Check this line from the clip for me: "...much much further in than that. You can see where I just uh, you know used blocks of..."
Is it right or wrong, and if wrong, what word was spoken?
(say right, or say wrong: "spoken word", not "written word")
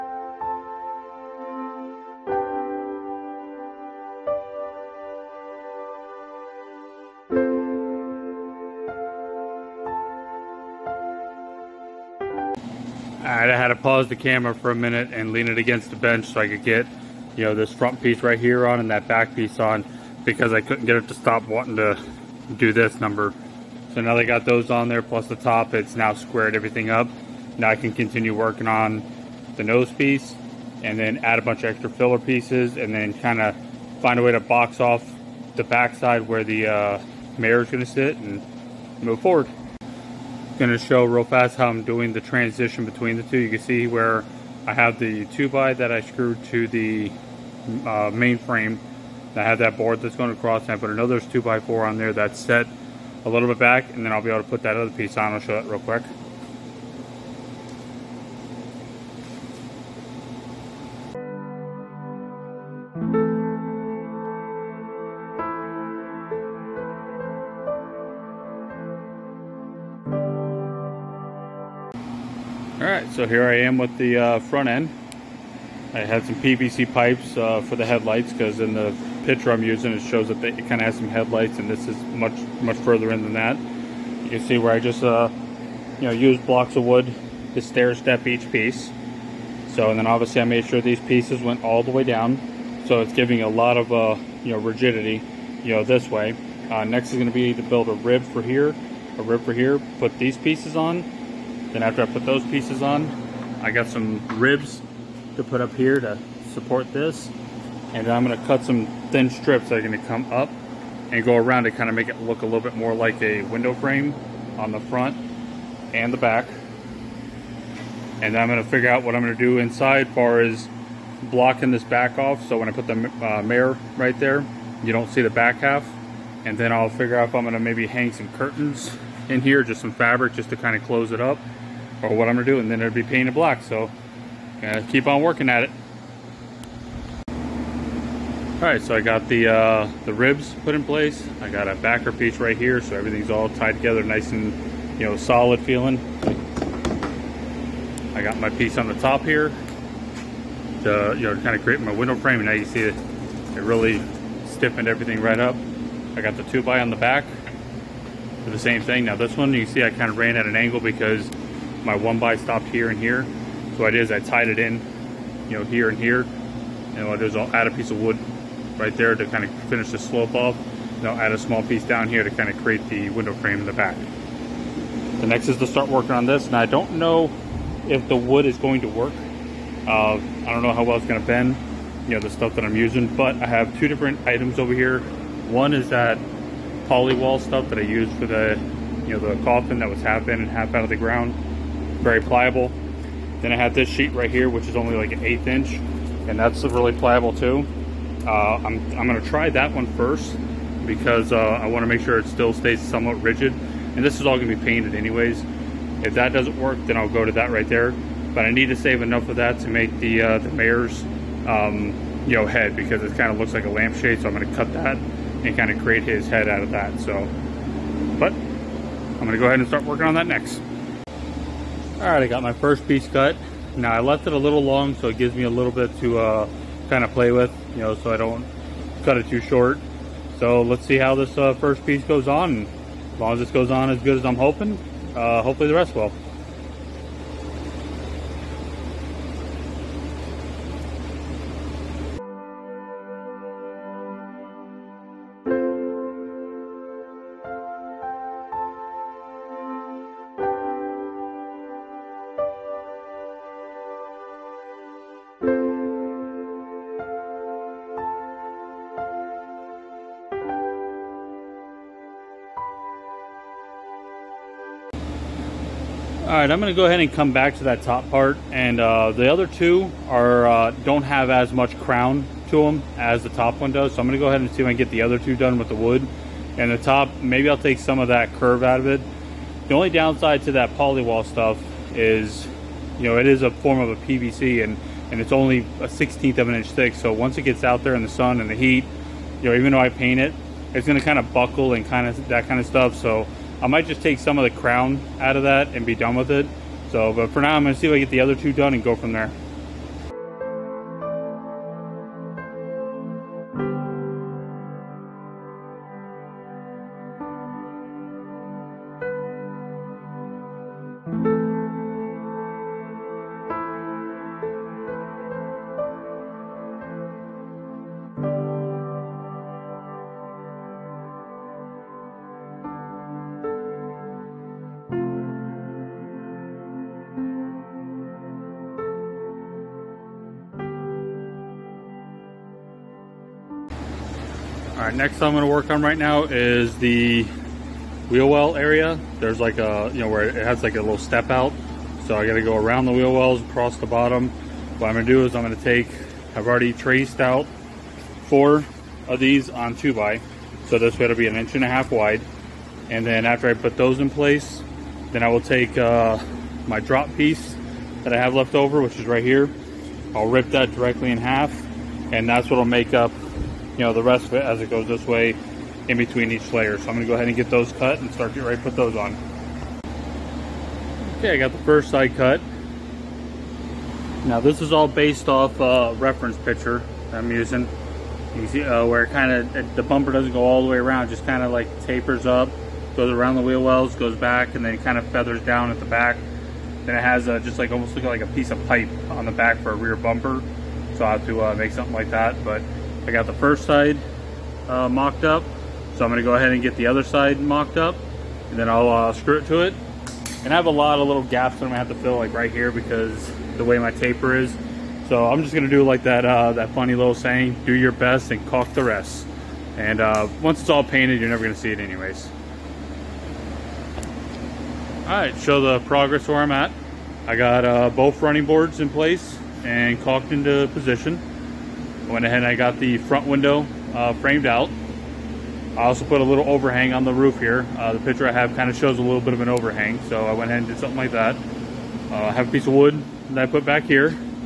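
right.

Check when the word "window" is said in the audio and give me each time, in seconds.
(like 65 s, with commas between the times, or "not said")
113 s, 151 s, 173 s, 423 s.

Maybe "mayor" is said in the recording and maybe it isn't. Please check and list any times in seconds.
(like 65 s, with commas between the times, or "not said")
37 s, 123 s, 210 s.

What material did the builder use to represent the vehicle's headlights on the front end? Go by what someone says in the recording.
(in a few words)
PVC pipes.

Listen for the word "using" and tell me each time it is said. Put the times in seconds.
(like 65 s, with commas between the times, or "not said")
79 s, 182 s, 377 s.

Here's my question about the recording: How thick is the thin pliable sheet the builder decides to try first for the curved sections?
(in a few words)
an eighth inch.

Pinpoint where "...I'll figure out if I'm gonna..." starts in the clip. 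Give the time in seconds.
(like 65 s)
126 s.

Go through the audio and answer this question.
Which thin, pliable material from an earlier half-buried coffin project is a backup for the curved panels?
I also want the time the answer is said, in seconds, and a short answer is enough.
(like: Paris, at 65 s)
poly wall, at 186 s.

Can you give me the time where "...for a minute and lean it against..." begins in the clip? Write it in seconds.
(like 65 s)
14 s.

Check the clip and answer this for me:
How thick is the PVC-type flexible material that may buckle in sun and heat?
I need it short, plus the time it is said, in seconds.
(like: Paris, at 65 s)
a 16th of an inch, at 285 s.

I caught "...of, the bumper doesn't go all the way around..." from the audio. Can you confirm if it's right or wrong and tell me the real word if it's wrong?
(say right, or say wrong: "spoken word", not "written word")
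right.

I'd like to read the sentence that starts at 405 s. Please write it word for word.
So I'm just gonna do like that, uh, that funny little saying, do your best and caulk the rest.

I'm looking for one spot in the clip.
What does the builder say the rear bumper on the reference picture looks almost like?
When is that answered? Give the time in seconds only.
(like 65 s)
388 s.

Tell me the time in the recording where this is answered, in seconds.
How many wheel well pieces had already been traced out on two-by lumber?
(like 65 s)
348 s.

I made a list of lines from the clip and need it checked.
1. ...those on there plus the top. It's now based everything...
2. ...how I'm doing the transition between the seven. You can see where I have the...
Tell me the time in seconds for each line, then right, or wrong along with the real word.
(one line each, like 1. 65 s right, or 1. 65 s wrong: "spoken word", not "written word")
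1. 24 s wrong: "squared", not "based"
2. 41 s wrong: "two", not "seven".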